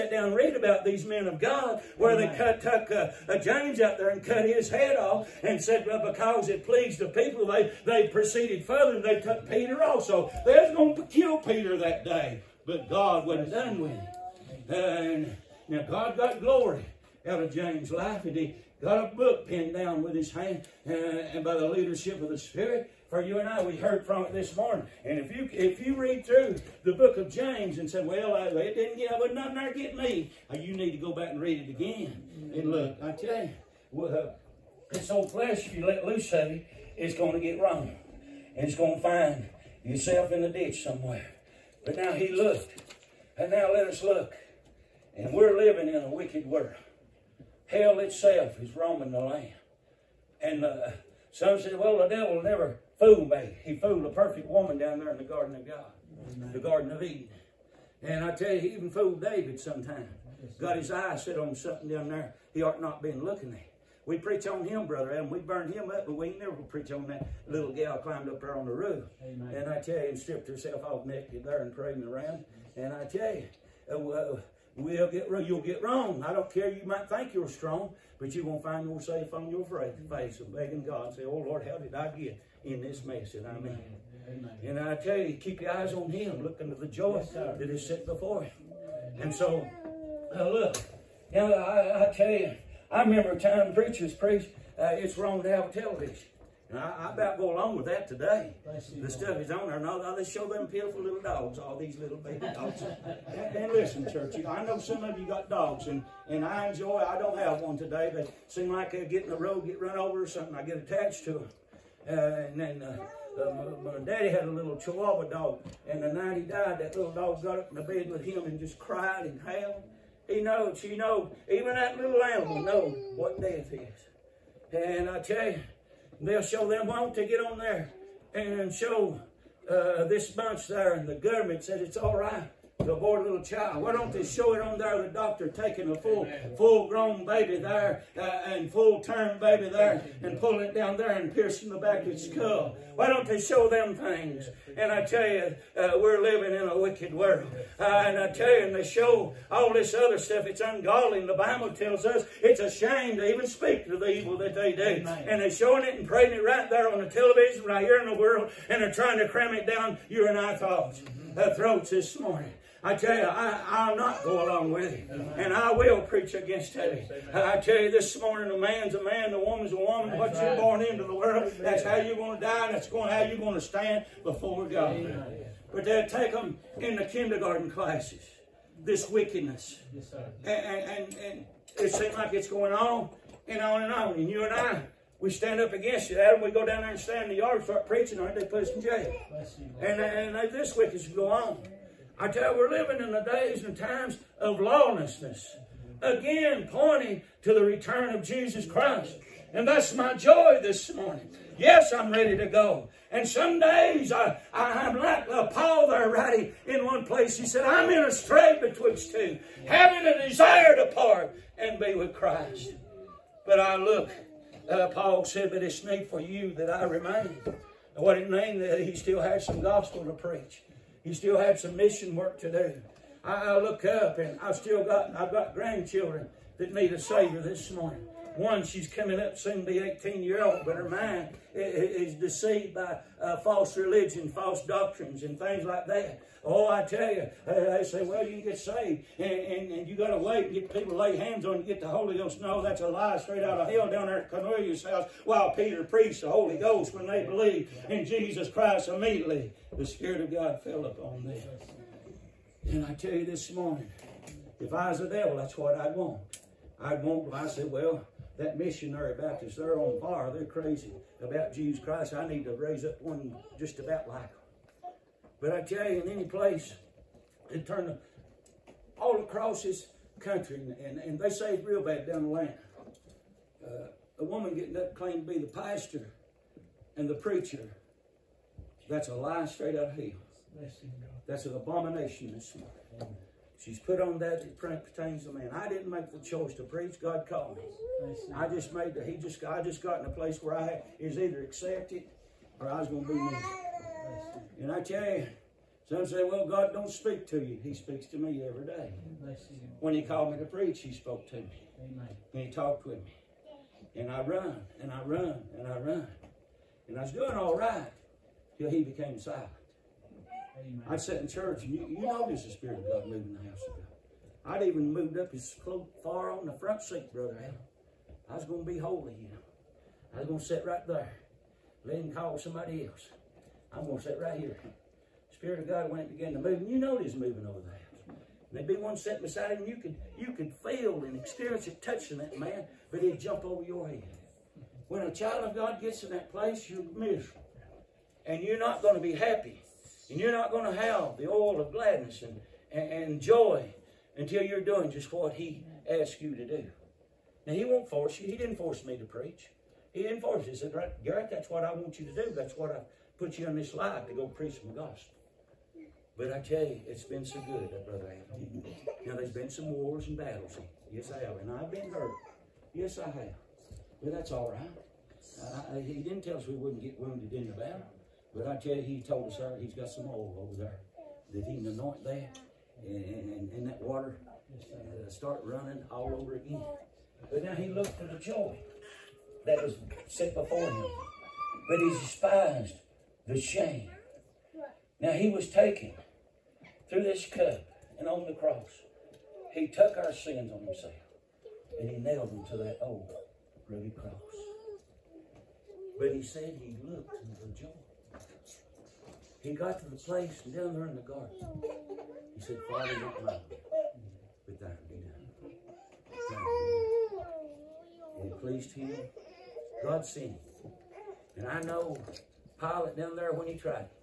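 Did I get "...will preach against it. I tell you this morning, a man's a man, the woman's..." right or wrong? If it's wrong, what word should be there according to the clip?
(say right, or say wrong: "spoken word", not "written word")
right.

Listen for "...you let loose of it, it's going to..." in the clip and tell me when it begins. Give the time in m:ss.
0:35.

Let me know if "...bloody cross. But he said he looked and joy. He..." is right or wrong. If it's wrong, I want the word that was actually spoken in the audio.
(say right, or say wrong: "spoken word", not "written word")
right.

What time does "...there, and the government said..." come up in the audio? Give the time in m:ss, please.
2:10.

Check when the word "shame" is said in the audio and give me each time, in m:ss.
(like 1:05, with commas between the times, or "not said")
2:32, 6:23.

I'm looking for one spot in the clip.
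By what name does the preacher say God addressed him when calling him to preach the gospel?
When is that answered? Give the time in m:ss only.
5:51.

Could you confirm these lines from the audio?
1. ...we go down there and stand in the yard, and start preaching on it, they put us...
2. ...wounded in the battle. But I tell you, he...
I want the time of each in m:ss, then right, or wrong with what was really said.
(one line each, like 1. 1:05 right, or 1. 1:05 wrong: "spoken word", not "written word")
1. 3:06 right
2. 6:06 right.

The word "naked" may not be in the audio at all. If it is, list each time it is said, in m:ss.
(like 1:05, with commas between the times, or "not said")
1:11.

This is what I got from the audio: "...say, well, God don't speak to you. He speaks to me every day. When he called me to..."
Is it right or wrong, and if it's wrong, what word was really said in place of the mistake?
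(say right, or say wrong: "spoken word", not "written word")
right.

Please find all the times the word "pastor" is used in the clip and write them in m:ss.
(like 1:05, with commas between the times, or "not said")
4:35.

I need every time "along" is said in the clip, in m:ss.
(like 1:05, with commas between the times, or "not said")
1:37, 2:44.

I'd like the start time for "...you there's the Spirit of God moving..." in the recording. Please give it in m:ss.
5:11.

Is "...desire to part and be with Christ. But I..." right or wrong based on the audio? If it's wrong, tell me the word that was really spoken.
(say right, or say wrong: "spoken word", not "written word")
right.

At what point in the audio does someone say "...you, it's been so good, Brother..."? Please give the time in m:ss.
5:56.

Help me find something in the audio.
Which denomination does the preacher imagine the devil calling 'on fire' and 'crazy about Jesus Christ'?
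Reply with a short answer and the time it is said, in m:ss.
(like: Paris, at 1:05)
Missionary Baptist, at 4:18.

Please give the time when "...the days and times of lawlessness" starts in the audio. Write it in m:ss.
3:13.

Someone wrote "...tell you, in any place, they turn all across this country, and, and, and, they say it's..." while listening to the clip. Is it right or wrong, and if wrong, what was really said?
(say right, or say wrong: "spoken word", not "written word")
right.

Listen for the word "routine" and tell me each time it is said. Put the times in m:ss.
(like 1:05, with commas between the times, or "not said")
not said.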